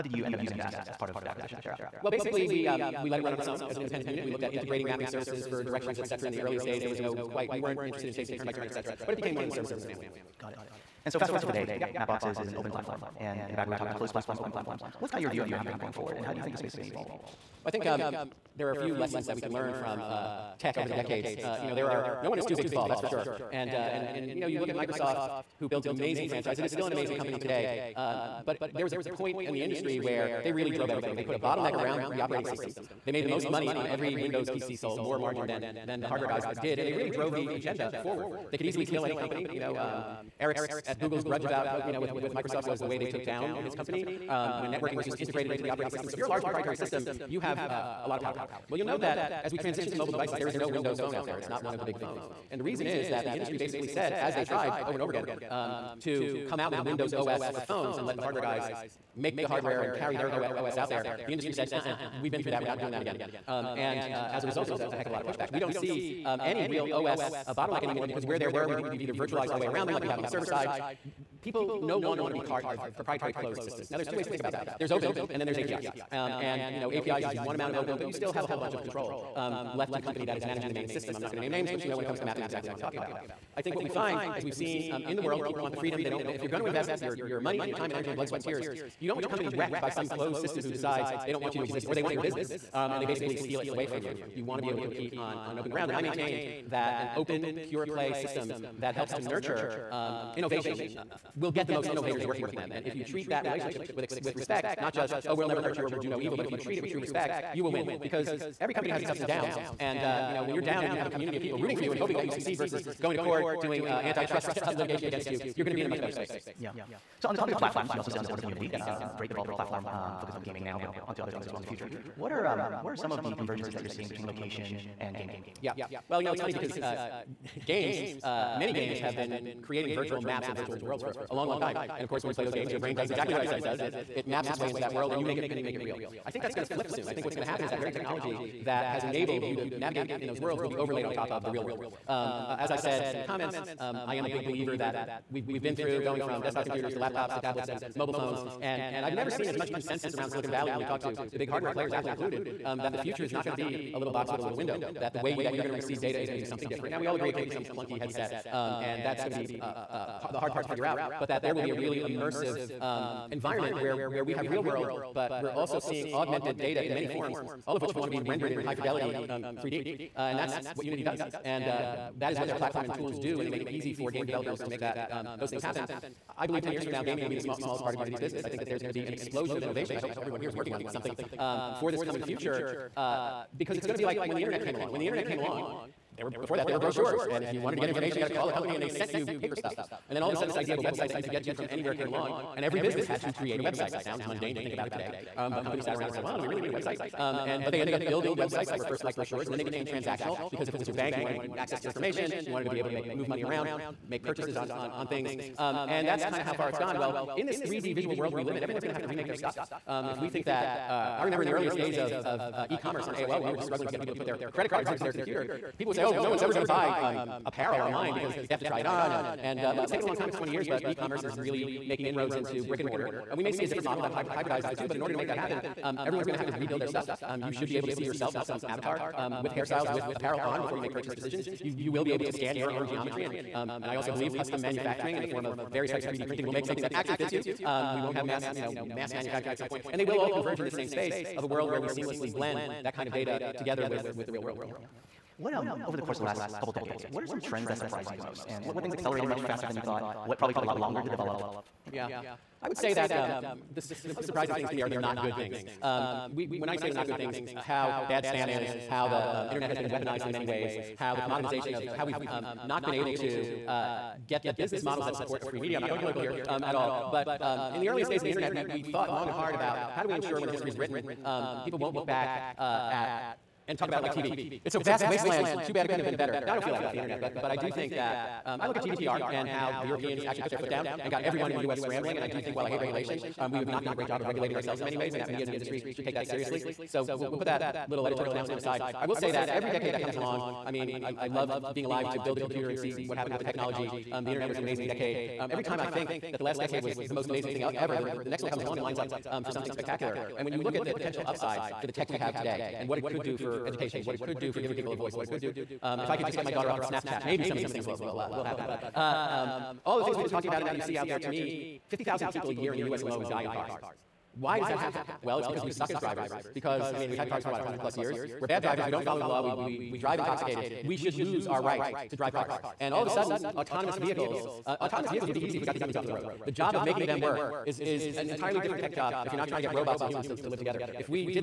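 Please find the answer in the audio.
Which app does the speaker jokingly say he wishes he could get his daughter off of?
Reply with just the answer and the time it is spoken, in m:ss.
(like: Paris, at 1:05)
Snapchat, at 5:06.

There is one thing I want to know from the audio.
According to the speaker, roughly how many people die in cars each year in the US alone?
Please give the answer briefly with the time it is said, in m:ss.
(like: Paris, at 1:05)
50,000, at 5:11.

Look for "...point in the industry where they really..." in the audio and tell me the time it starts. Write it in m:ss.
0:29.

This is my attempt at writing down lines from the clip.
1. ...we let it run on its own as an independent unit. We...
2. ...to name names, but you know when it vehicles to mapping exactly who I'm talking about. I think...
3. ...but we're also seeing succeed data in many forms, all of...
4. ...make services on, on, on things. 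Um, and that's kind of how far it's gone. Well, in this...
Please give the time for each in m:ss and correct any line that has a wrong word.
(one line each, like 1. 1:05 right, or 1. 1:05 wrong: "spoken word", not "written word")
1. 0:03 right
2. 1:21 wrong: "comes", not "vehicles"
3. 2:45 wrong: "augmented", not "succeed"
4. 3:24 wrong: "purchases", not "services".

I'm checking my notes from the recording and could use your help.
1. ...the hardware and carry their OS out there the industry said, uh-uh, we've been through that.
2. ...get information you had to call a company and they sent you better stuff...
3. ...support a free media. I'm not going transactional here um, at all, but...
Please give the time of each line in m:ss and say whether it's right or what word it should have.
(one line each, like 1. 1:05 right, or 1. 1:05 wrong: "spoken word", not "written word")
1. 0:59 right
2. 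3:07 wrong: "paper", not "better"
3. 4:25 wrong: "political", not "transactional".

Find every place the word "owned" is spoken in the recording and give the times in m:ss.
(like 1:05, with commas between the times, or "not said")
not said.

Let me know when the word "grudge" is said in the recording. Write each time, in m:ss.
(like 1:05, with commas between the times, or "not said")
0:41.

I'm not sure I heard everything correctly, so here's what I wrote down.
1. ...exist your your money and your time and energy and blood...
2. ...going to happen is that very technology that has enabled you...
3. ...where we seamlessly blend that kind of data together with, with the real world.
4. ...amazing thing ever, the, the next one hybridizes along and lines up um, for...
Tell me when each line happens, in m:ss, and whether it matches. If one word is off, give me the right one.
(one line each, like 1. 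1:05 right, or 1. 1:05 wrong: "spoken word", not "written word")
1. 1:26 wrong: "invest", not "exist"
2. 2:17 right
3. 4:01 right
4. 4:57 wrong: "comes", not "hybridizes".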